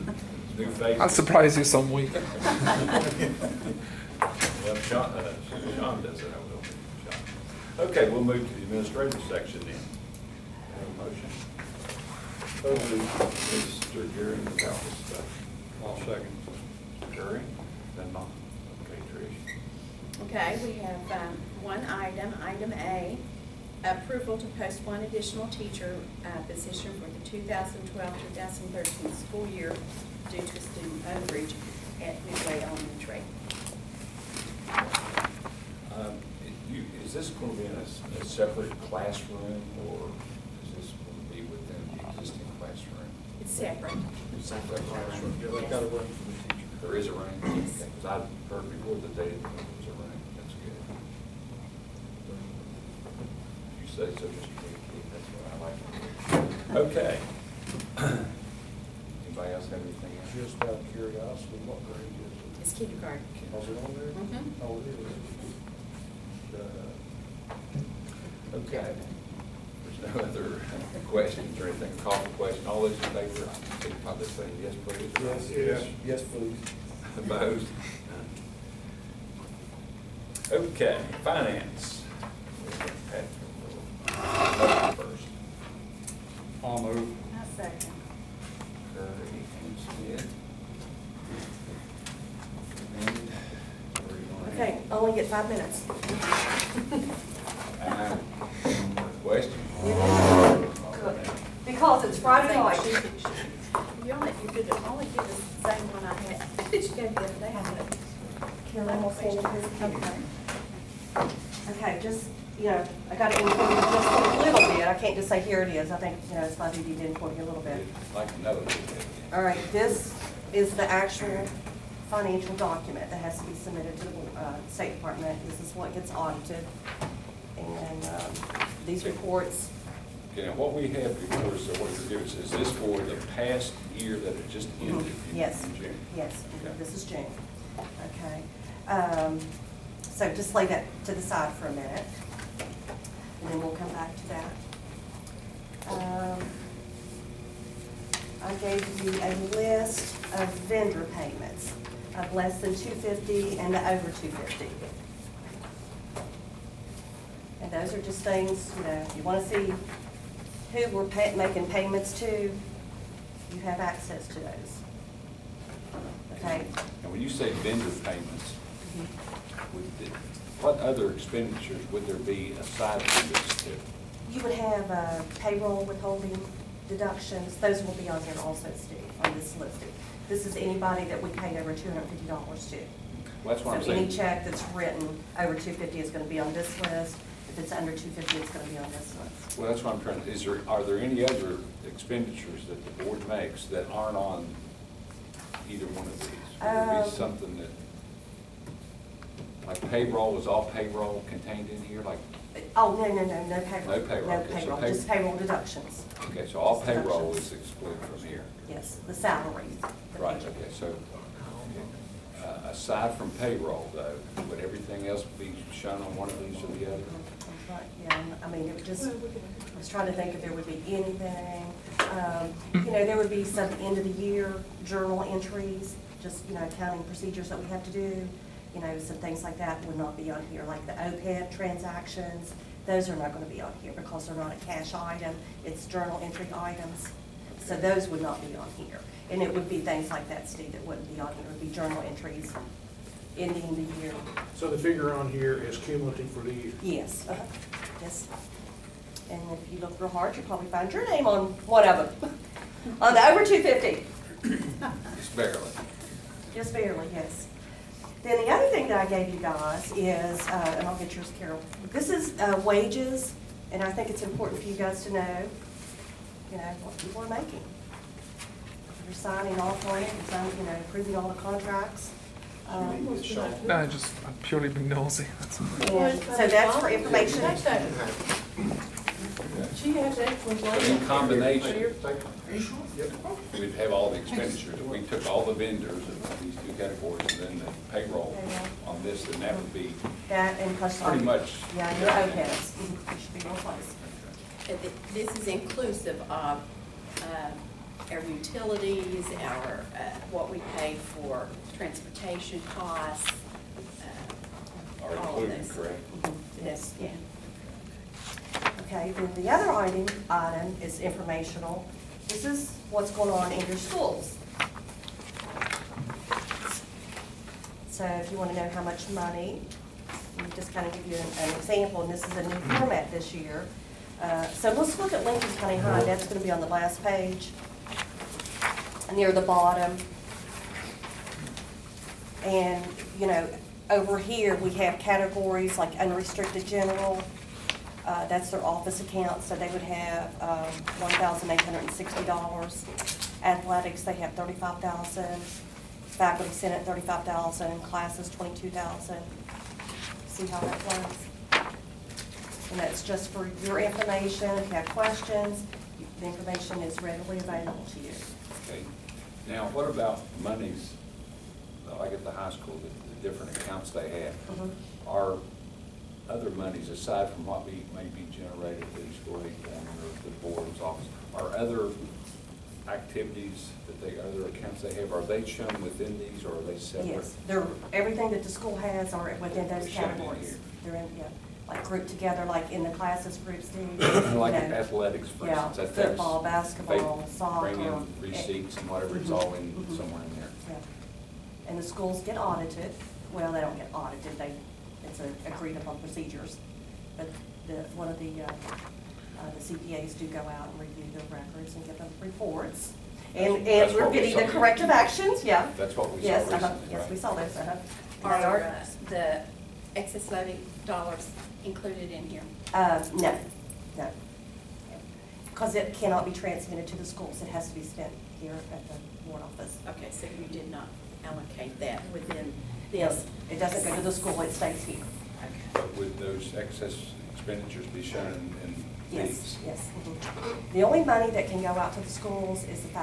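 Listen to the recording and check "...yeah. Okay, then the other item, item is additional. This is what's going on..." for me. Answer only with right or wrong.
wrong.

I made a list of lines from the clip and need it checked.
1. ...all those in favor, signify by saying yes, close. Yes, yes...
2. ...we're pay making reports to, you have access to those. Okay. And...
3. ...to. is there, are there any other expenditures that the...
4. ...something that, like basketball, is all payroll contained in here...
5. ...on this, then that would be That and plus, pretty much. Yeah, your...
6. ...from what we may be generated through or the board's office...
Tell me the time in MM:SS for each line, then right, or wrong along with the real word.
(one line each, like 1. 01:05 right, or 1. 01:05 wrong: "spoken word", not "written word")
1. 01:12 wrong: "please", not "close"
2. 02:40 wrong: "payments", not "reports"
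3. 03:10 right
4. 03:17 wrong: "payroll", not "basketball"
5. 04:48 right
6. 06:07 right.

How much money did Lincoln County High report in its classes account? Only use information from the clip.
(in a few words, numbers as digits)
22000.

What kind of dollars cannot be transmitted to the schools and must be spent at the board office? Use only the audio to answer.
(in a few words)
Excess levy dollars.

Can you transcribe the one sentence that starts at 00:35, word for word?
Um, you, is this going to be in a, a, separate classroom or is this going to be within the existing classroom?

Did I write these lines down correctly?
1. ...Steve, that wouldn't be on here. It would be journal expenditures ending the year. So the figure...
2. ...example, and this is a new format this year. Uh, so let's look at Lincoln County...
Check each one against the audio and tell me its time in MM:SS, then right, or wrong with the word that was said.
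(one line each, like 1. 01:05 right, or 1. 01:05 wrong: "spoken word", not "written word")
1. 04:00 wrong: "entries", not "expenditures"
2. 05:21 right.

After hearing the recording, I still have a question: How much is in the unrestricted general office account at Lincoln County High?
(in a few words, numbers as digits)
$1,860.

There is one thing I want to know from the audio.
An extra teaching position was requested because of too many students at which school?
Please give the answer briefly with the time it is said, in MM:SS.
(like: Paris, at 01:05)
Midway Elementary, at 00:32.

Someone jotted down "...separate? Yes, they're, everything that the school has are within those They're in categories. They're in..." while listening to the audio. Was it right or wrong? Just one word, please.
right.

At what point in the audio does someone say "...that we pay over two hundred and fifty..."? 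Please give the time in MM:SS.
03:01.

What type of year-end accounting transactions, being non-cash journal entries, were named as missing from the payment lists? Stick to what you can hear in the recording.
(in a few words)
OPEB transactions.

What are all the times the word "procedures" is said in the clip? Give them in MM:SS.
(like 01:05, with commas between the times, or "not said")
03:47, 06:35.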